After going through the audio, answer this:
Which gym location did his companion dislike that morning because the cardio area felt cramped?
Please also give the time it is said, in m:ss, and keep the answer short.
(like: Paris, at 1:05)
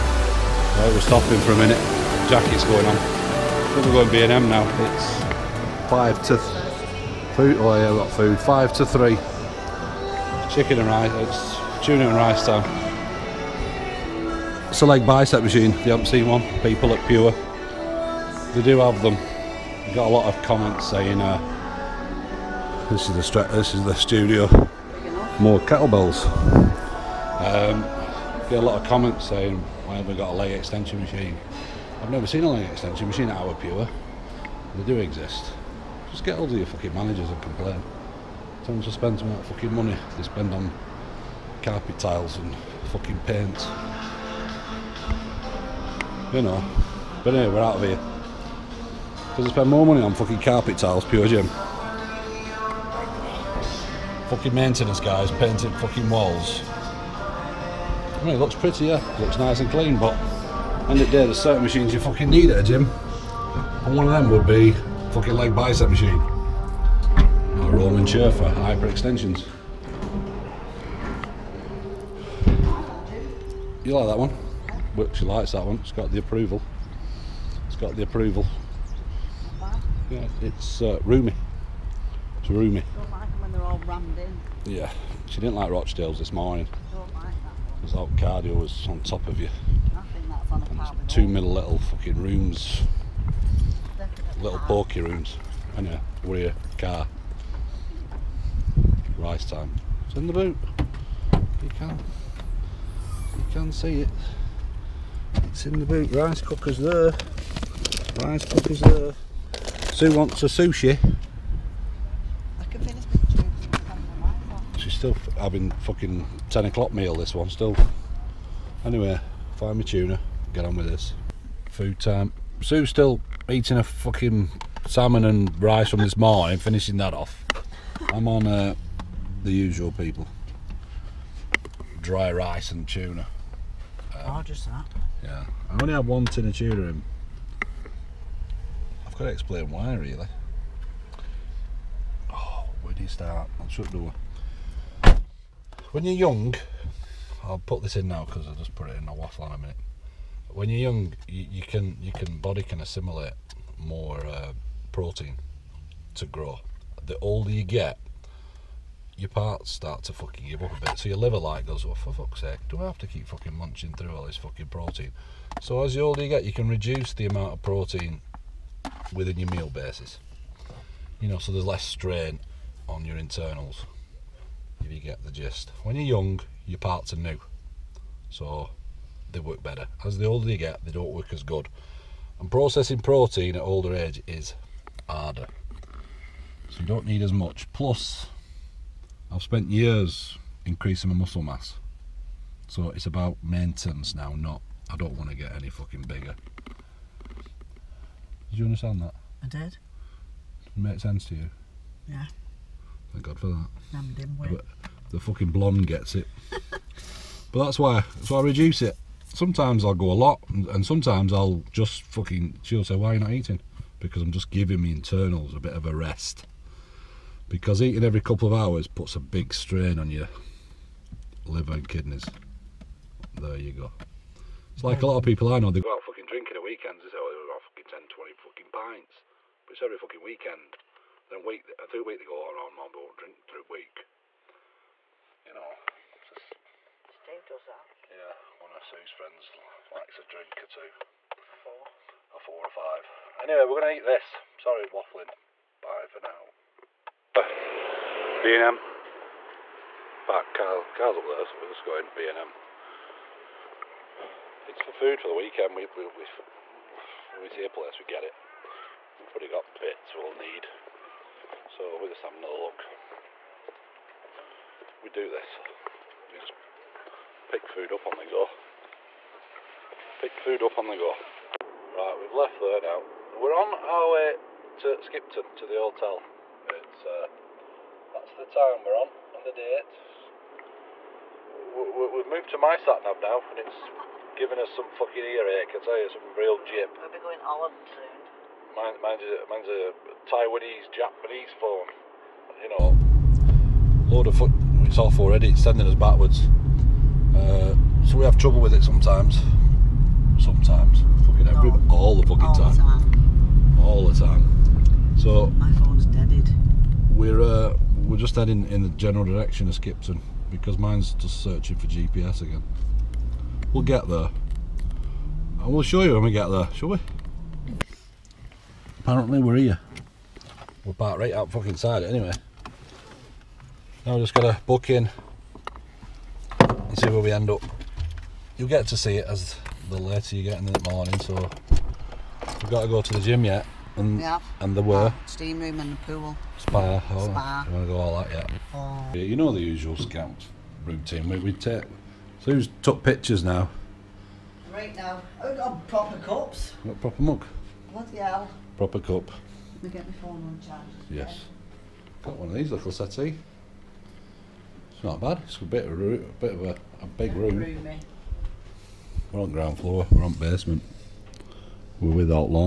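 Rochdale, at 1:25.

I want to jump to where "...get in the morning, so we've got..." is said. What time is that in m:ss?
5:30.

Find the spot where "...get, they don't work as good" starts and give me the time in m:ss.
3:00.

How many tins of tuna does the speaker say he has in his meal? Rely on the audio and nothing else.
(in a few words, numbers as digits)
1.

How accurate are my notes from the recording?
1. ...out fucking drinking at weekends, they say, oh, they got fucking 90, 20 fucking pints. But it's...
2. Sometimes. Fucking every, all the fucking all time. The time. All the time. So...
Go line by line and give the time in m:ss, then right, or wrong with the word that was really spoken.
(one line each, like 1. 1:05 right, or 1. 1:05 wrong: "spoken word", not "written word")
1. 3:45 wrong: "10", not "90"
2. 5:00 right.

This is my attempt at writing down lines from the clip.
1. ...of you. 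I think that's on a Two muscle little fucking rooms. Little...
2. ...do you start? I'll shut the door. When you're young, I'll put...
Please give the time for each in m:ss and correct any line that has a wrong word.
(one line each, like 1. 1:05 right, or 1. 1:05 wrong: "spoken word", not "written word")
1. 1:29 wrong: "middle", not "muscle"
2. 2:22 right.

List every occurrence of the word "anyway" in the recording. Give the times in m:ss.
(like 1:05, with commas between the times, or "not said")
0:47, 1:58, 4:03, 5:22.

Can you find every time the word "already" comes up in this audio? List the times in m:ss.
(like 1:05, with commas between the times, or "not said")
4:19, 4:55.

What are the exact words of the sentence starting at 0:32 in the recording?
I've never seen a leg extension machine at our Pure.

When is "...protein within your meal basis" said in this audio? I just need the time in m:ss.
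2:47.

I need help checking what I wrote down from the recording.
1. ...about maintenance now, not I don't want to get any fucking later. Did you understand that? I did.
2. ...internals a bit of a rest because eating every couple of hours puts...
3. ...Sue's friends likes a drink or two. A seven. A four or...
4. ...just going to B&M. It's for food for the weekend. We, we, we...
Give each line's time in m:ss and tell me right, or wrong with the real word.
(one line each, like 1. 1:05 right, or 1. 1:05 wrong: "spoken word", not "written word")
1. 3:13 wrong: "bigger", not "later"
2. 3:34 right
3. 3:58 wrong: "four", not "seven"
4. 4:11 right.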